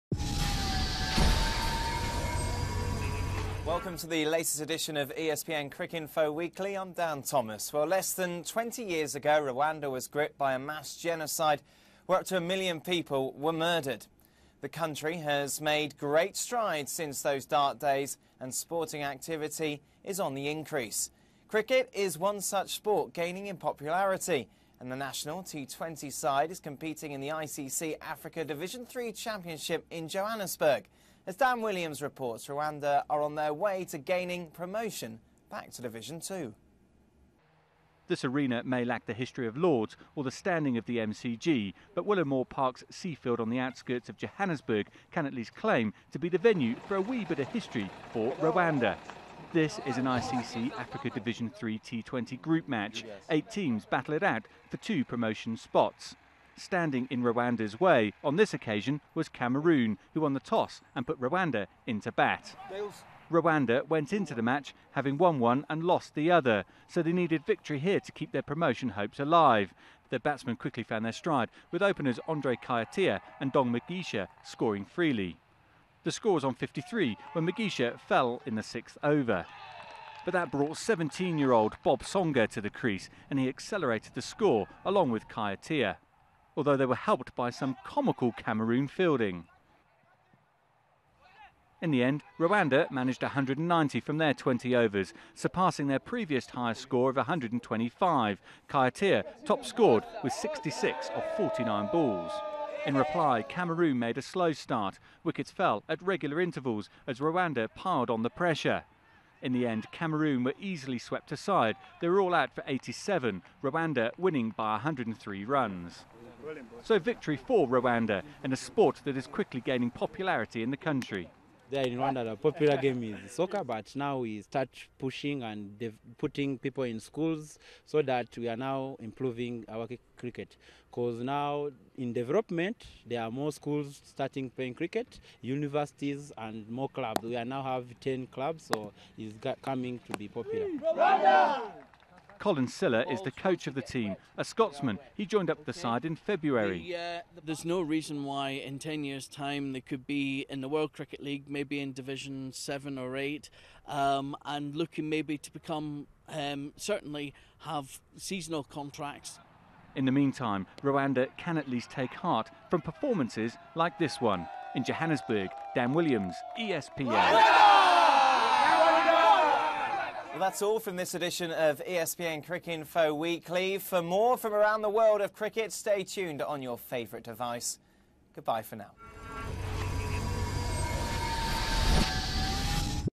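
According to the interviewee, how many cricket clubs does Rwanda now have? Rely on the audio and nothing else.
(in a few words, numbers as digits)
10.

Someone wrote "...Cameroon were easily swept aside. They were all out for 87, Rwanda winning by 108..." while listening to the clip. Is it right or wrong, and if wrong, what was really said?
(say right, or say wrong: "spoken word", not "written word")
wrong: "103", not "108".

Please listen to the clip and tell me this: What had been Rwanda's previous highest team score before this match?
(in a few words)
125.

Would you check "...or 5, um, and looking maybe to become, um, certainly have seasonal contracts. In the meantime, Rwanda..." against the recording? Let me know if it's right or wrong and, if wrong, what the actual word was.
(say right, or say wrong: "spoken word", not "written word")
wrong: "8", not "5".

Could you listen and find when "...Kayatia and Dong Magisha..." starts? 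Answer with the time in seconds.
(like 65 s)
72 s.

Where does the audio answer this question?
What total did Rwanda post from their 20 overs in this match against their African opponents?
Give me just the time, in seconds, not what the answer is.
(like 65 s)
93 s.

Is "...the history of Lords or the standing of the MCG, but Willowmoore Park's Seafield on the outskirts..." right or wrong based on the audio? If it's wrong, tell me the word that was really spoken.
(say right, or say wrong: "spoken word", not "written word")
right.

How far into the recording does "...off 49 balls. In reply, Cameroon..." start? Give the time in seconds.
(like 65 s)
101 s.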